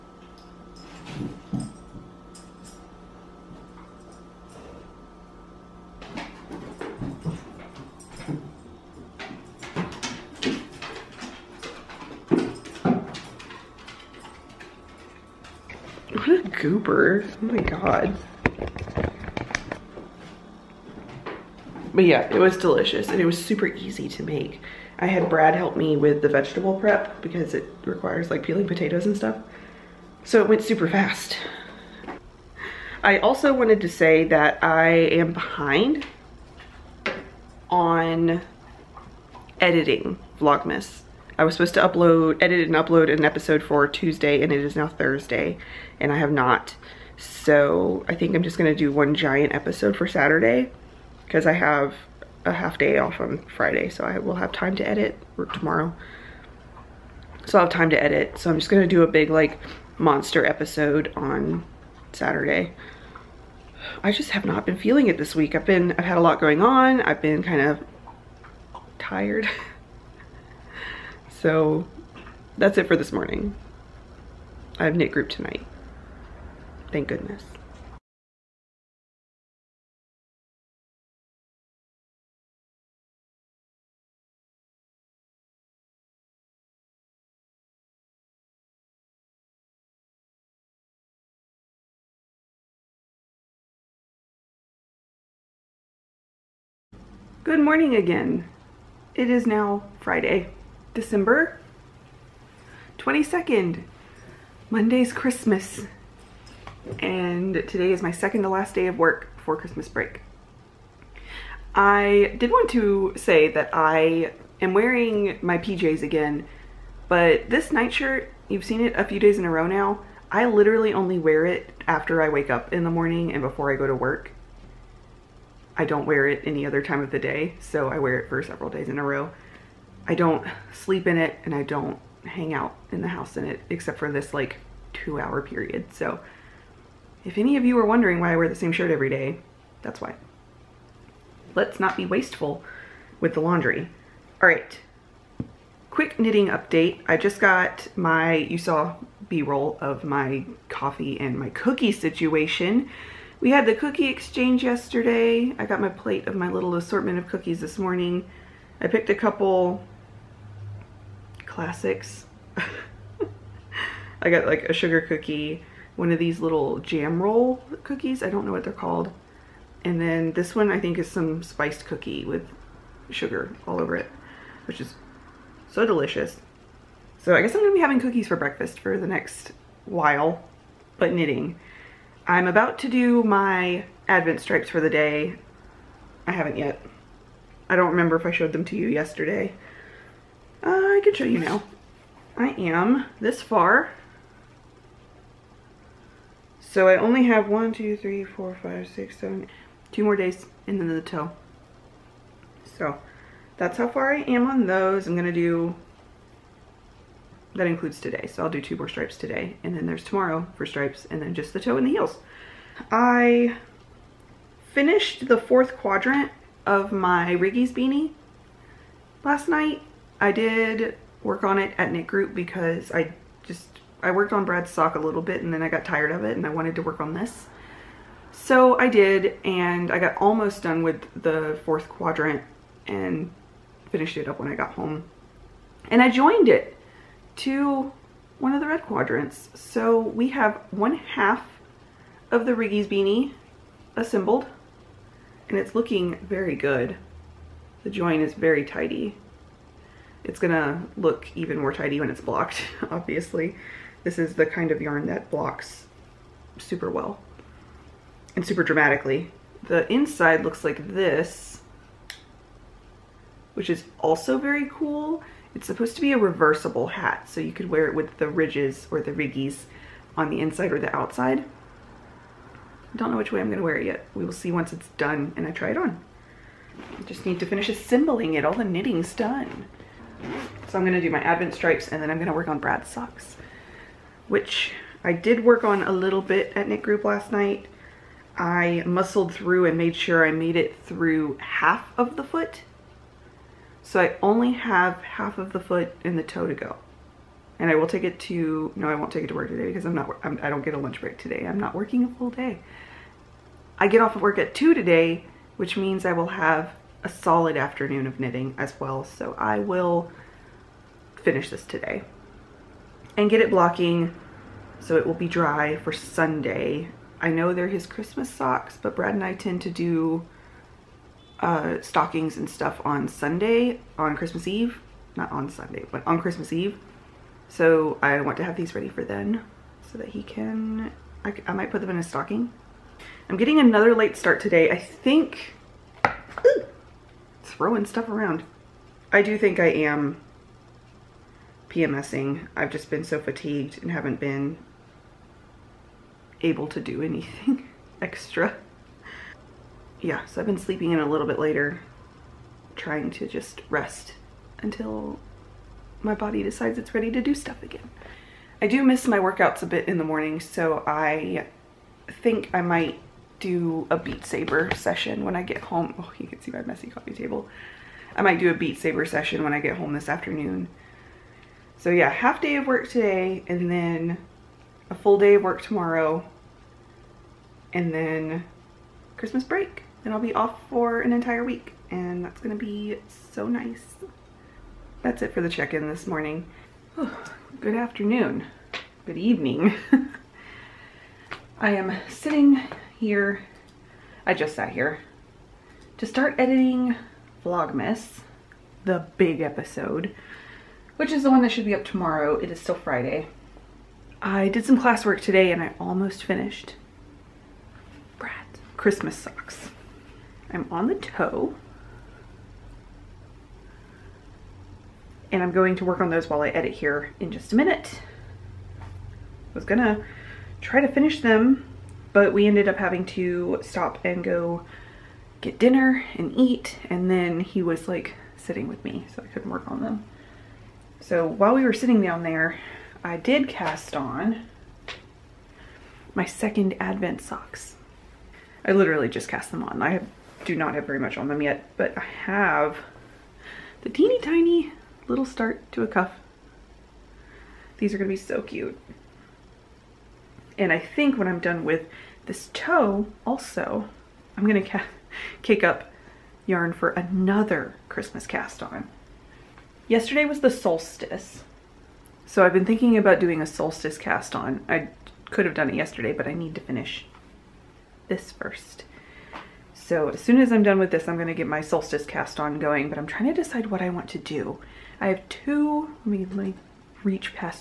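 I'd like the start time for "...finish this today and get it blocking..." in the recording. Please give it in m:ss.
5:11.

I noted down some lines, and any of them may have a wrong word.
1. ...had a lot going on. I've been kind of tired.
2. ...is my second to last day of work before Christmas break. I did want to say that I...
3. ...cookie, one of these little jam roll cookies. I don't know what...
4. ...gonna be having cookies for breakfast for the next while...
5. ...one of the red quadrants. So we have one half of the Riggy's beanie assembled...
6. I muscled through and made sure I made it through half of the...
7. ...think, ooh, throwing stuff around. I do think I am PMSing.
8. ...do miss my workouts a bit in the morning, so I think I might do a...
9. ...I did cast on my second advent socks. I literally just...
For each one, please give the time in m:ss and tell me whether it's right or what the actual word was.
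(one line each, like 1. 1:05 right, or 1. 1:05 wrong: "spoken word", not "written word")
1. 1:06 right
2. 1:47 right
3. 2:45 right
4. 2:57 right
5. 3:58 right
6. 4:48 right
7. 5:34 right
8. 5:58 right
9. 7:13 right.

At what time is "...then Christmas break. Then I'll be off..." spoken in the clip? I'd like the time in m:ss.
6:17.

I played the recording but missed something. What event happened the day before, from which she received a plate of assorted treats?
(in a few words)
Cookie exchange.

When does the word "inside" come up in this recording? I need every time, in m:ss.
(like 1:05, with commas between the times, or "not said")
4:19, 4:30.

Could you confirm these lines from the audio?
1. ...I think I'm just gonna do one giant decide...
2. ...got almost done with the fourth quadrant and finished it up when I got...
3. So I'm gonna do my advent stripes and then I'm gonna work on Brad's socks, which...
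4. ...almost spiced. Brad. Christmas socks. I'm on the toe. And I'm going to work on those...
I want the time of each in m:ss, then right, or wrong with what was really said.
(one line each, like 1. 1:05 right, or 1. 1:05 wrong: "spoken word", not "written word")
1. 0:48 wrong: "episode", not "decide"
2. 3:49 right
3. 4:40 right
4. 6:45 wrong: "finished", not "spiced".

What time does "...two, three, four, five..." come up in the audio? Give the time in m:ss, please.
3:17.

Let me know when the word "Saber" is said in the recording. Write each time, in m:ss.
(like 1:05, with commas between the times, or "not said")
6:04, 6:08.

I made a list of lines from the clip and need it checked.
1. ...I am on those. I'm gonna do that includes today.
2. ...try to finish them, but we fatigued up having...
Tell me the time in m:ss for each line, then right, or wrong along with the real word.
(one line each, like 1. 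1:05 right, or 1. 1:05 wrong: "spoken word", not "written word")
1. 3:24 right
2. 7:00 wrong: "ended", not "fatigued".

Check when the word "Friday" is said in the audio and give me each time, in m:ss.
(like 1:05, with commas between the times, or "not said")
0:53, 1:39, 6:42.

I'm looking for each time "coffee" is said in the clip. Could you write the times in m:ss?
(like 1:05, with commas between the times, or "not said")
2:30, 6:06.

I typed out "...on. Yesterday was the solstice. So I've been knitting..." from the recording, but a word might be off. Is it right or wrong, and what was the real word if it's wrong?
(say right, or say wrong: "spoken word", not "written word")
wrong: "thinking", not "knitting".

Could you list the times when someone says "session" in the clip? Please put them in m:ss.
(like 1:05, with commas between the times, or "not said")
6:04, 6:09.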